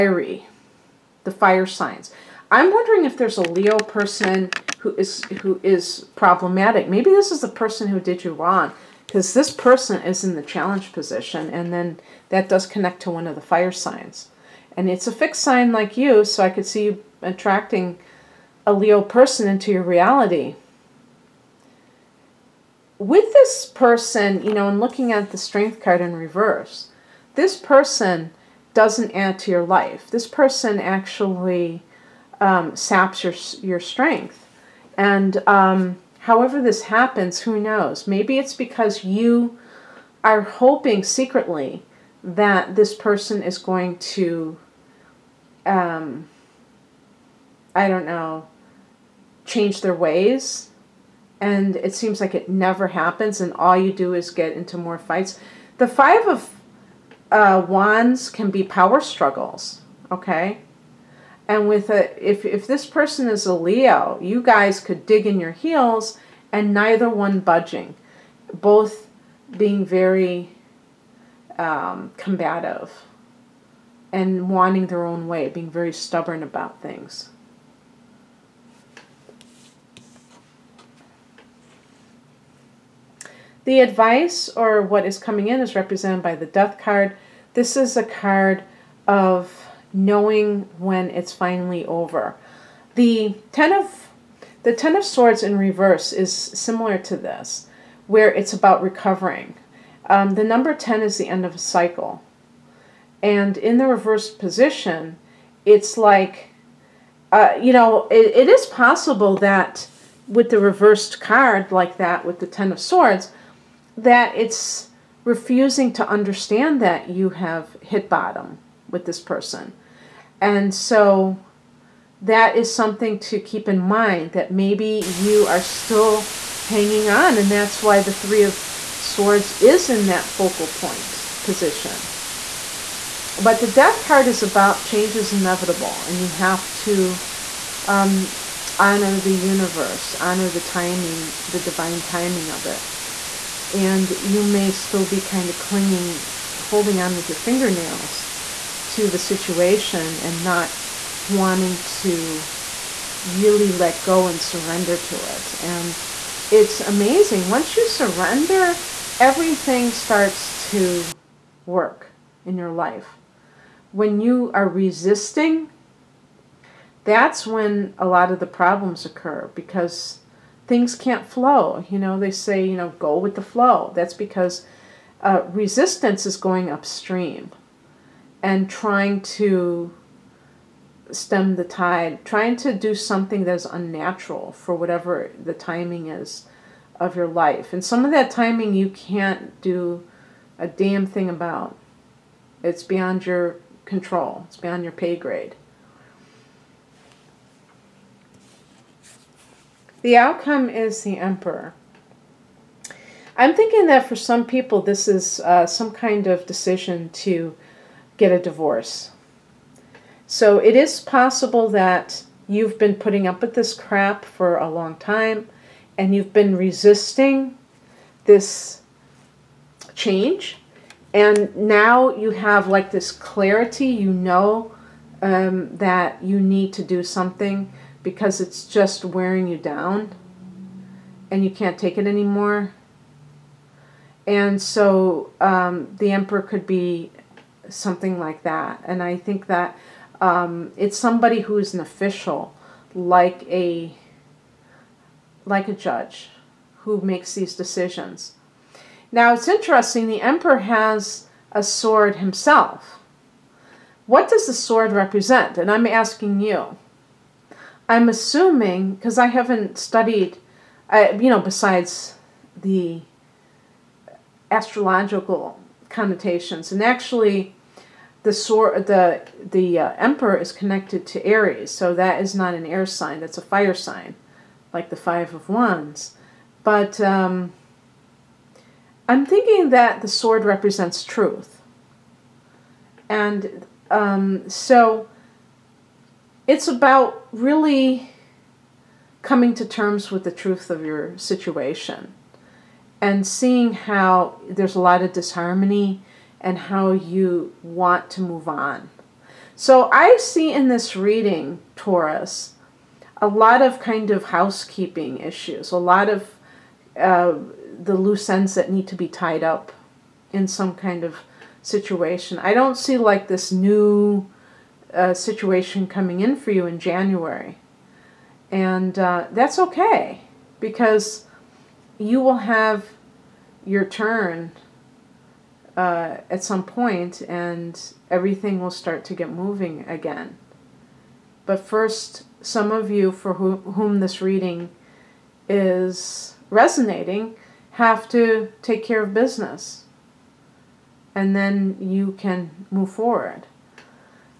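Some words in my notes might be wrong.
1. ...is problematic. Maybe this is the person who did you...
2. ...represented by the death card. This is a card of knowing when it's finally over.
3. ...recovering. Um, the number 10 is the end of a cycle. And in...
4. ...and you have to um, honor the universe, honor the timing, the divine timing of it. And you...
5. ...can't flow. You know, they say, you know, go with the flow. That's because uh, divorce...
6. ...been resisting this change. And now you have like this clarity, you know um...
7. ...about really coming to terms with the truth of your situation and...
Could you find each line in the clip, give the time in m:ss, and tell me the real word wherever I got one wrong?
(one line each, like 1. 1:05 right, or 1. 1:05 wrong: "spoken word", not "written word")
1. 0:05 right
2. 1:25 right
3. 1:38 right
4. 2:16 right
5. 2:50 wrong: "resistance", not "divorce"
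6. 3:36 right
7. 4:46 right.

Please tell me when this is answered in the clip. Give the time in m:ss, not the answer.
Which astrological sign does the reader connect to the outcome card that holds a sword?
4:31.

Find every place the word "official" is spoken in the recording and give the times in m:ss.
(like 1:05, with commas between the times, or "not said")
4:01.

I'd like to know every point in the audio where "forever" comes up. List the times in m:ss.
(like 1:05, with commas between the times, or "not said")
not said.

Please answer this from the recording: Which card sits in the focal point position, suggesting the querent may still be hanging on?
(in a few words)
Three of Swords.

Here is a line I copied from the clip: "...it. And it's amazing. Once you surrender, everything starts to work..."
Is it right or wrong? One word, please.
right.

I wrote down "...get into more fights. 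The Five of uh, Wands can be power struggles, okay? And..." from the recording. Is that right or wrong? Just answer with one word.
right.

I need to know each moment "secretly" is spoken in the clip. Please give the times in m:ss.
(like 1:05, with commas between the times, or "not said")
0:41.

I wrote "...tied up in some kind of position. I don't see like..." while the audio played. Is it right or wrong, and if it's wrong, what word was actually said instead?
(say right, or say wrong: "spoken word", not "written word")
wrong: "situation", not "position".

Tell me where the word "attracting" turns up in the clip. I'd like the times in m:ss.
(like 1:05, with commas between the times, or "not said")
0:17.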